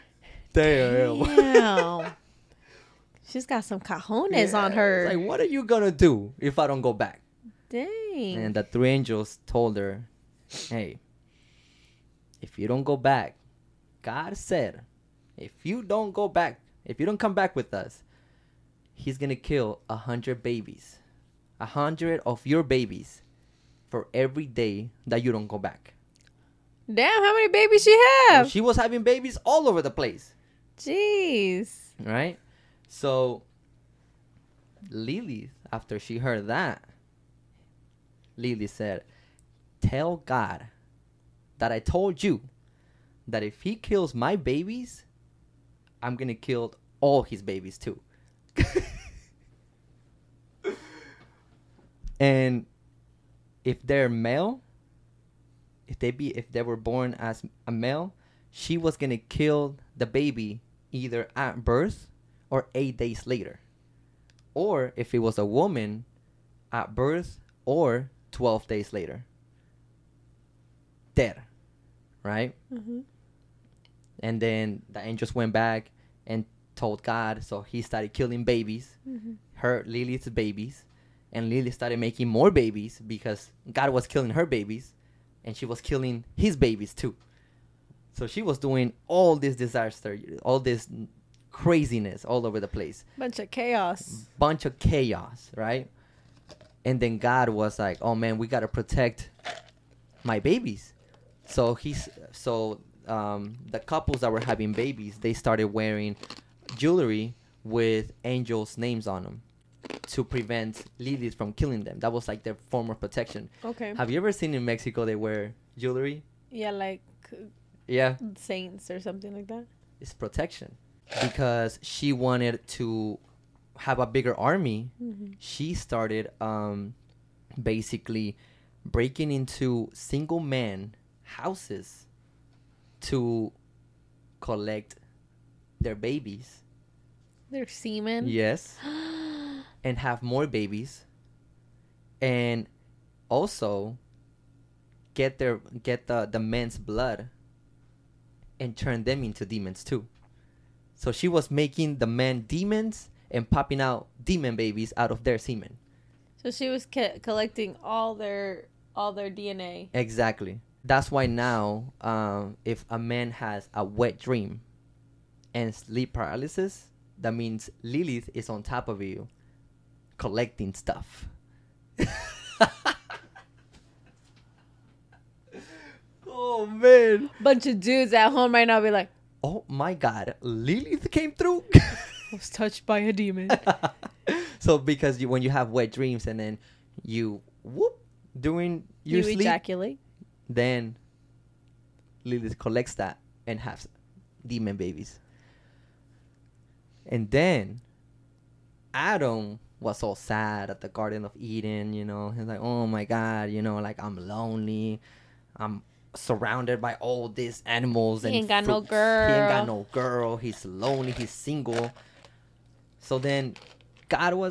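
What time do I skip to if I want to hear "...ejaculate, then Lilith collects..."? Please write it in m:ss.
3:09.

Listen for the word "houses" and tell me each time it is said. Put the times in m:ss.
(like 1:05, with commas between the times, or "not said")
2:11.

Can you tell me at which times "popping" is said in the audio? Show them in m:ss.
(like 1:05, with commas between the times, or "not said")
2:33.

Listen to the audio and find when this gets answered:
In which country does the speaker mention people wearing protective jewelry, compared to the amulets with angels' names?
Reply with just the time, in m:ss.
1:54.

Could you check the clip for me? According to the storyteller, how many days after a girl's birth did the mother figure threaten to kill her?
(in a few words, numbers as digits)
12.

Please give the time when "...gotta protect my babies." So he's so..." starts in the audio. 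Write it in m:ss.
1:38.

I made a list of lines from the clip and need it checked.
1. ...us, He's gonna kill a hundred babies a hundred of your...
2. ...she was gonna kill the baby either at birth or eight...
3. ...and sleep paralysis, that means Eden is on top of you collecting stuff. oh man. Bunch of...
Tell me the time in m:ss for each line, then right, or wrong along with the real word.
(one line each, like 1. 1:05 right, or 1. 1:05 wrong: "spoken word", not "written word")
1. 0:17 right
2. 0:58 right
3. 2:45 wrong: "Lilith", not "Eden".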